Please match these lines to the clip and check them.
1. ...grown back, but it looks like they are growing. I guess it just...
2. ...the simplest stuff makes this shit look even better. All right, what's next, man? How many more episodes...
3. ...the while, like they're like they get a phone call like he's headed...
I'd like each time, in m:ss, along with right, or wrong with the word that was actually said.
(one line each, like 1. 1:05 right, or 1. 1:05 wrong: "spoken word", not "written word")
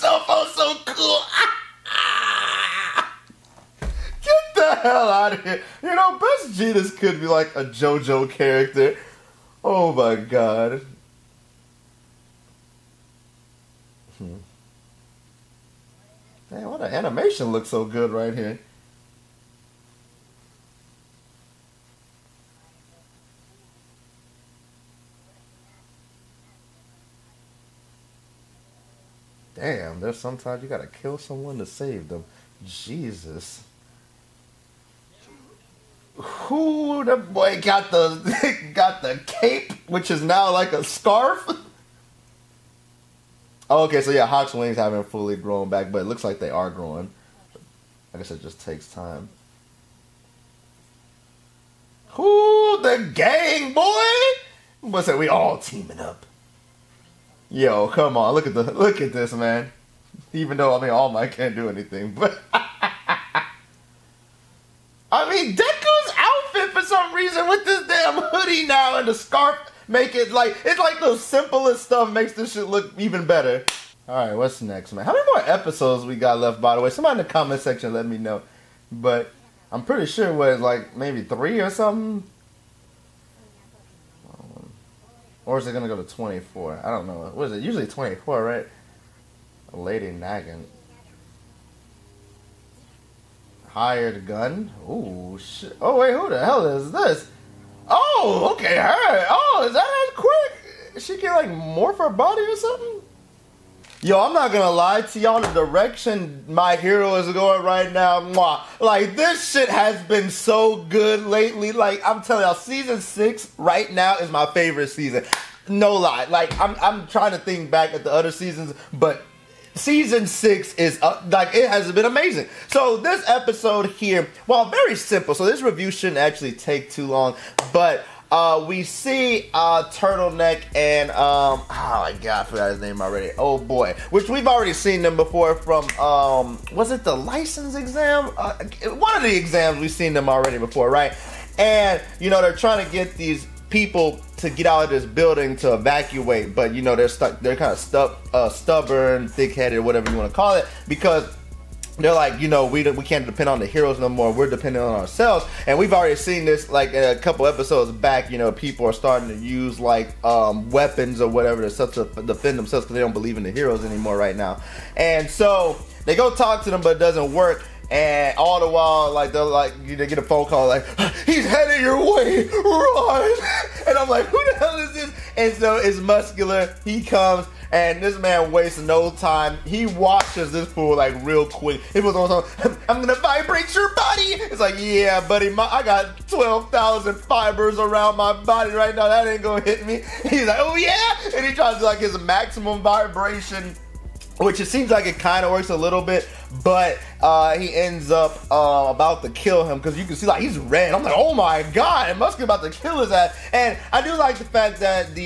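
1. 0:45 right
2. 1:11 right
3. 2:48 right.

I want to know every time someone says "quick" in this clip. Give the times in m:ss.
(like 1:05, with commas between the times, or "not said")
1:40, 3:01.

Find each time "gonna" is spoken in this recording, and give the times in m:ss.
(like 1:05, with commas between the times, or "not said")
1:44, 3:03, 3:09.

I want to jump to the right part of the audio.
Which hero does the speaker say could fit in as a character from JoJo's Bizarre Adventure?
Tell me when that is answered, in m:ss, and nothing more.
0:06.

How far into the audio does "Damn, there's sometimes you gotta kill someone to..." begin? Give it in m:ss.
0:29.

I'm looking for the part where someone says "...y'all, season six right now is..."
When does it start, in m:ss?
1:52.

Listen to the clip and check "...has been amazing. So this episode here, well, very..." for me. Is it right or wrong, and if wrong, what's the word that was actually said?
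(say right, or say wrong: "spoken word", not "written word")
right.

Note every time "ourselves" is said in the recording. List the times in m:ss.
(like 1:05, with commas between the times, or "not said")
2:34.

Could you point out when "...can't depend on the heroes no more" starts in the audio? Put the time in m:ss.
2:33.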